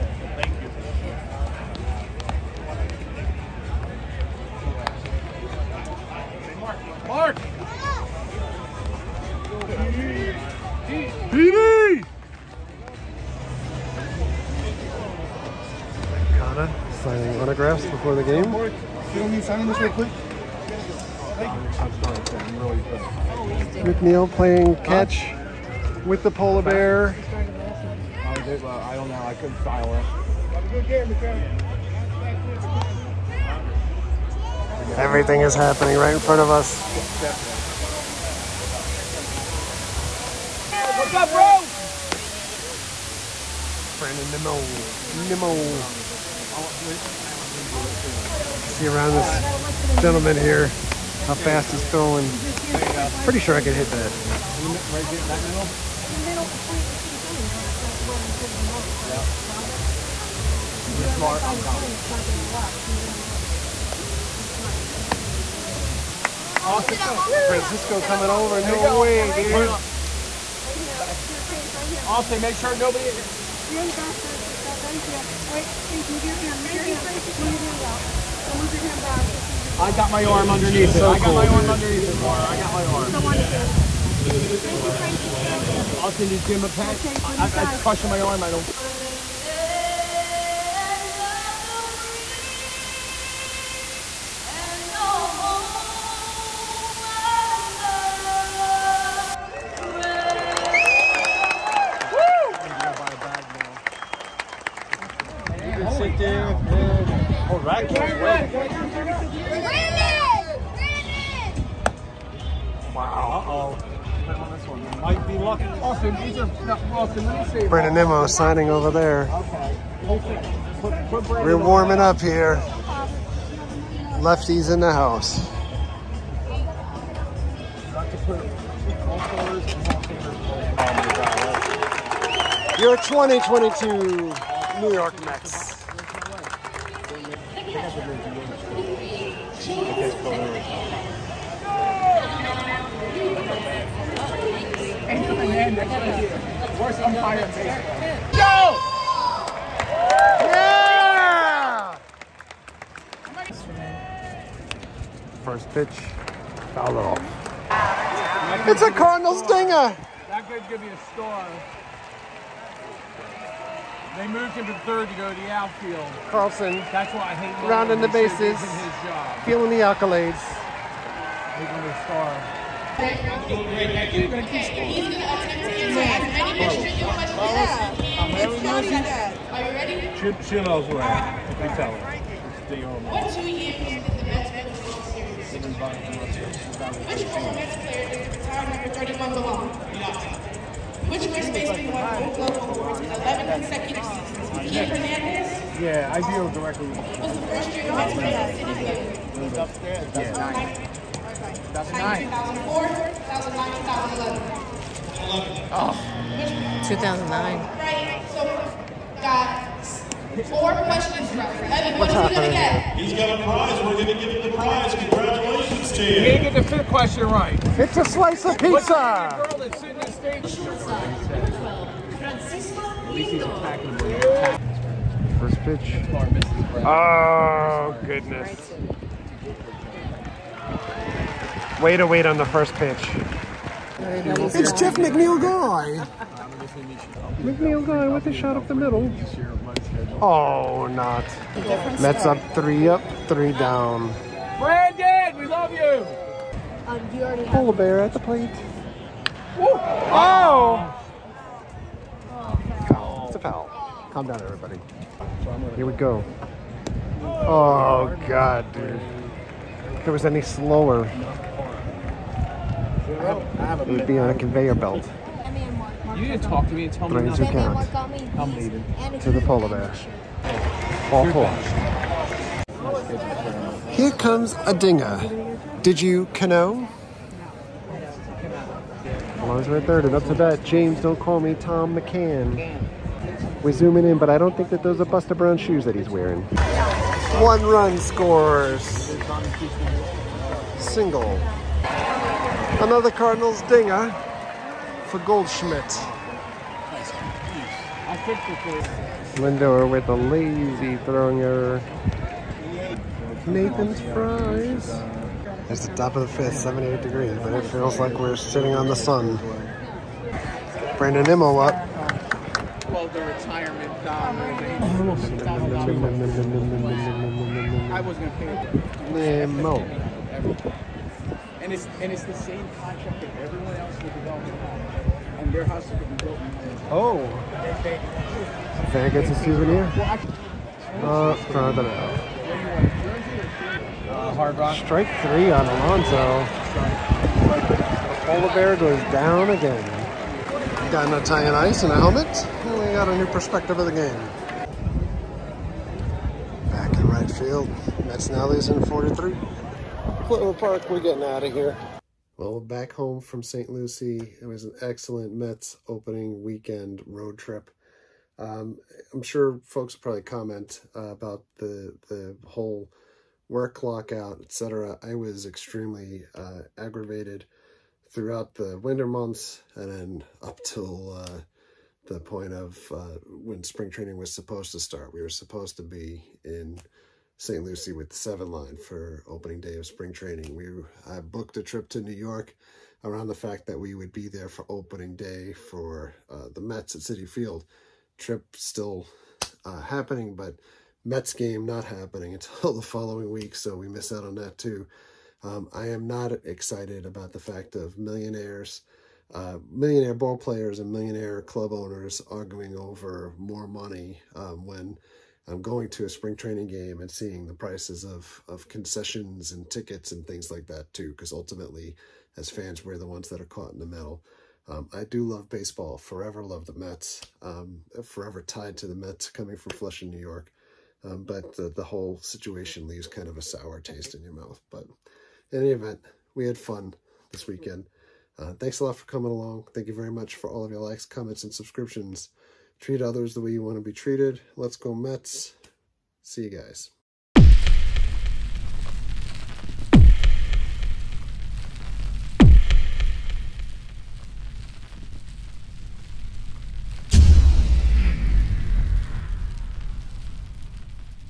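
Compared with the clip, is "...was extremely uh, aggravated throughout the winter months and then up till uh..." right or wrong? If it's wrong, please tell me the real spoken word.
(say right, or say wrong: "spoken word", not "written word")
right.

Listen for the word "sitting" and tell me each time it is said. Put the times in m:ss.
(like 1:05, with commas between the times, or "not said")
3:39, 5:08.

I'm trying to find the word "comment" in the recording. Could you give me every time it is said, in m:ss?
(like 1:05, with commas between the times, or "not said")
6:00, 7:11.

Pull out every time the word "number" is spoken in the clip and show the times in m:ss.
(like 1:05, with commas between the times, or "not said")
3:08.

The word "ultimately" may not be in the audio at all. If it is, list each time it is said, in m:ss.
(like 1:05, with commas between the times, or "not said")
6:51.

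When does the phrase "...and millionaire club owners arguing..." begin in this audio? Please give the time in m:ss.
6:40.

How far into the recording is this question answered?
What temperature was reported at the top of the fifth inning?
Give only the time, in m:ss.
5:06.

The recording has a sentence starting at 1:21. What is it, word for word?
I got cool, my arm underneath it, Mara.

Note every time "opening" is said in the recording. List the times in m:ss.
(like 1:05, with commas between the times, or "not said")
5:55, 6:19, 6:24.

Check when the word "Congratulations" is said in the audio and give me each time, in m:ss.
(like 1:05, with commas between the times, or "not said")
3:34.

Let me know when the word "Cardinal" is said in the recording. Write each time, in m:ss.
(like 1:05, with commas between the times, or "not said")
2:38, 4:53.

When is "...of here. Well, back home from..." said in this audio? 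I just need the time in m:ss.
5:51.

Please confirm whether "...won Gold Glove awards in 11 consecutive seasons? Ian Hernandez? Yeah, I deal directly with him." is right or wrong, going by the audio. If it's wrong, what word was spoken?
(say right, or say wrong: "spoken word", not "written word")
right.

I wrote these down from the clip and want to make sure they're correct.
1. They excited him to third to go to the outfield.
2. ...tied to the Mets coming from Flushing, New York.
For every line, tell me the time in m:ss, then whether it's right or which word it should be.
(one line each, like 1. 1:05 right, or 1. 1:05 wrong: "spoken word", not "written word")
1. 2:44 wrong: "moved", not "excited"
2. 6:58 right.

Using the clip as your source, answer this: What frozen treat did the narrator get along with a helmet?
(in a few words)
Italian ice.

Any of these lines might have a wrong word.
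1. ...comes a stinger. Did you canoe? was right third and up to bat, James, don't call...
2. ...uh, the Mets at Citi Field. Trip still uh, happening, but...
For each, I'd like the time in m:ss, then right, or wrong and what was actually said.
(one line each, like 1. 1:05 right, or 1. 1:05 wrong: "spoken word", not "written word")
1. 4:34 wrong: "dinger", not "stinger"
2. 6:26 right.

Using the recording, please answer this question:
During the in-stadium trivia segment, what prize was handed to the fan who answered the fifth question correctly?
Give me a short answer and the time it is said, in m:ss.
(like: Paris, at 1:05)
A slice of pizza, at 3:38.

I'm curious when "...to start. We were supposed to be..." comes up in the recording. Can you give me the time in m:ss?
6:14.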